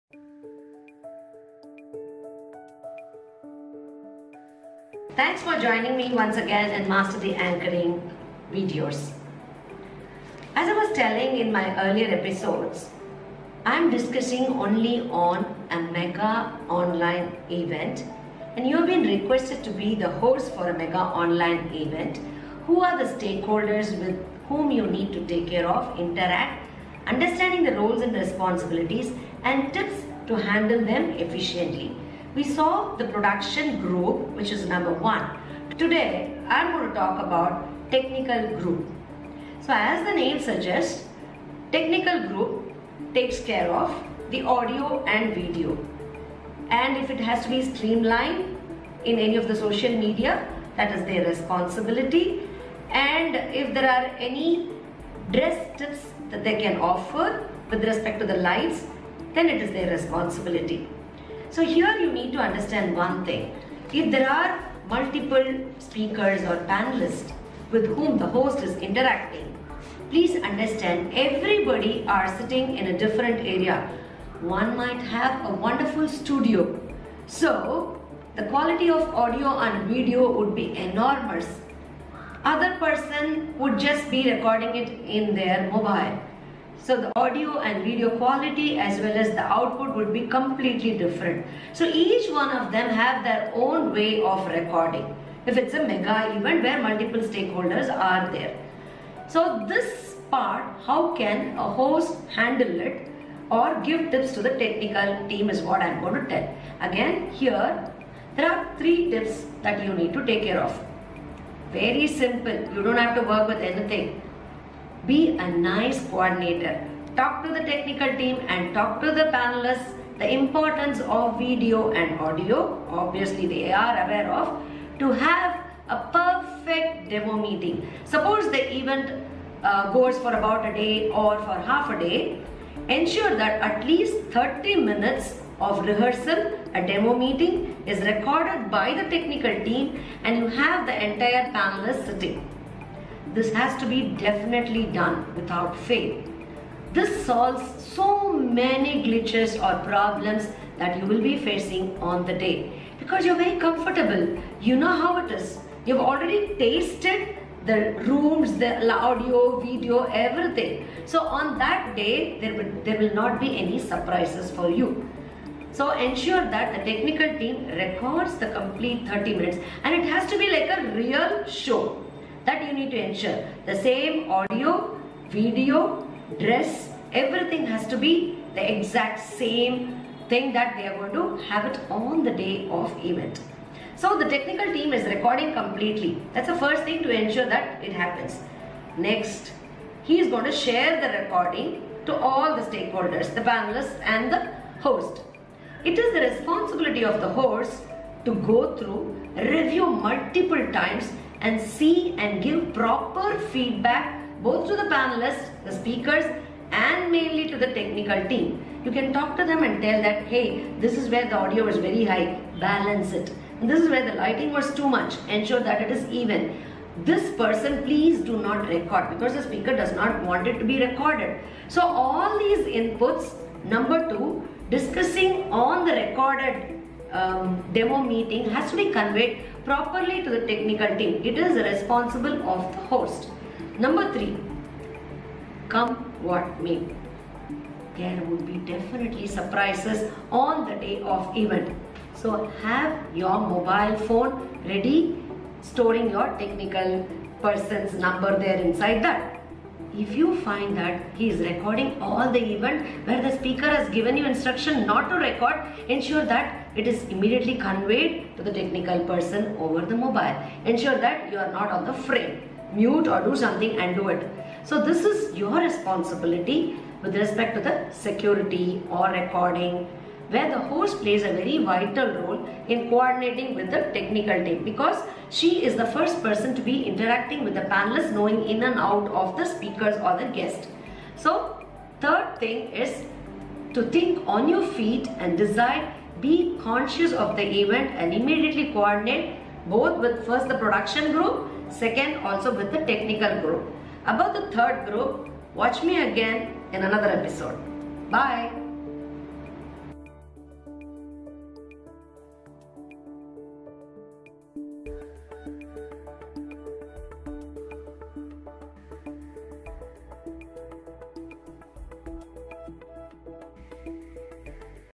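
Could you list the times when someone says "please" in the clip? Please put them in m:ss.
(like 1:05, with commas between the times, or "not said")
1:10, 3:37.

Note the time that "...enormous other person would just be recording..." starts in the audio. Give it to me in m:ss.
1:20.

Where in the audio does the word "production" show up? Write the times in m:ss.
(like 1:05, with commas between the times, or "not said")
0:33, 4:50.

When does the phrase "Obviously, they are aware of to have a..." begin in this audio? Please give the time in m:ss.
2:02.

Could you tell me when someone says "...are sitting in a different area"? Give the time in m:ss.
1:12.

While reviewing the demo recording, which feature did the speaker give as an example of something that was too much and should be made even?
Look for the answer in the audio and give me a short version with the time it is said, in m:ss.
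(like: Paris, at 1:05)
Lighting, at 3:34.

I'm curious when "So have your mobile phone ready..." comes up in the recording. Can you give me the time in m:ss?
4:02.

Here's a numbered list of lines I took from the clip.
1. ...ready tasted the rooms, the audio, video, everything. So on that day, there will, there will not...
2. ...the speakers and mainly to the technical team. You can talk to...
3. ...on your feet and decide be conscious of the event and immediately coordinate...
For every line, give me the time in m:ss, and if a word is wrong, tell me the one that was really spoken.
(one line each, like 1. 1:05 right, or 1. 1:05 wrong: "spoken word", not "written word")
1. 2:36 wrong: "already", not "ready"
2. 3:25 right
3. 4:44 right.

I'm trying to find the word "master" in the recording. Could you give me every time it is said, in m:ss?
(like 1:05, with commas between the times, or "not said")
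0:06.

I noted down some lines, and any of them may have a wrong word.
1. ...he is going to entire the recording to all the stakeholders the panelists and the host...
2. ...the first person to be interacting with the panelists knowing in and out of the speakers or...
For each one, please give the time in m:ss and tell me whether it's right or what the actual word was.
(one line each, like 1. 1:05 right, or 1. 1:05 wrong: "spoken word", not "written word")
1. 3:10 wrong: "share", not "entire"
2. 4:35 right.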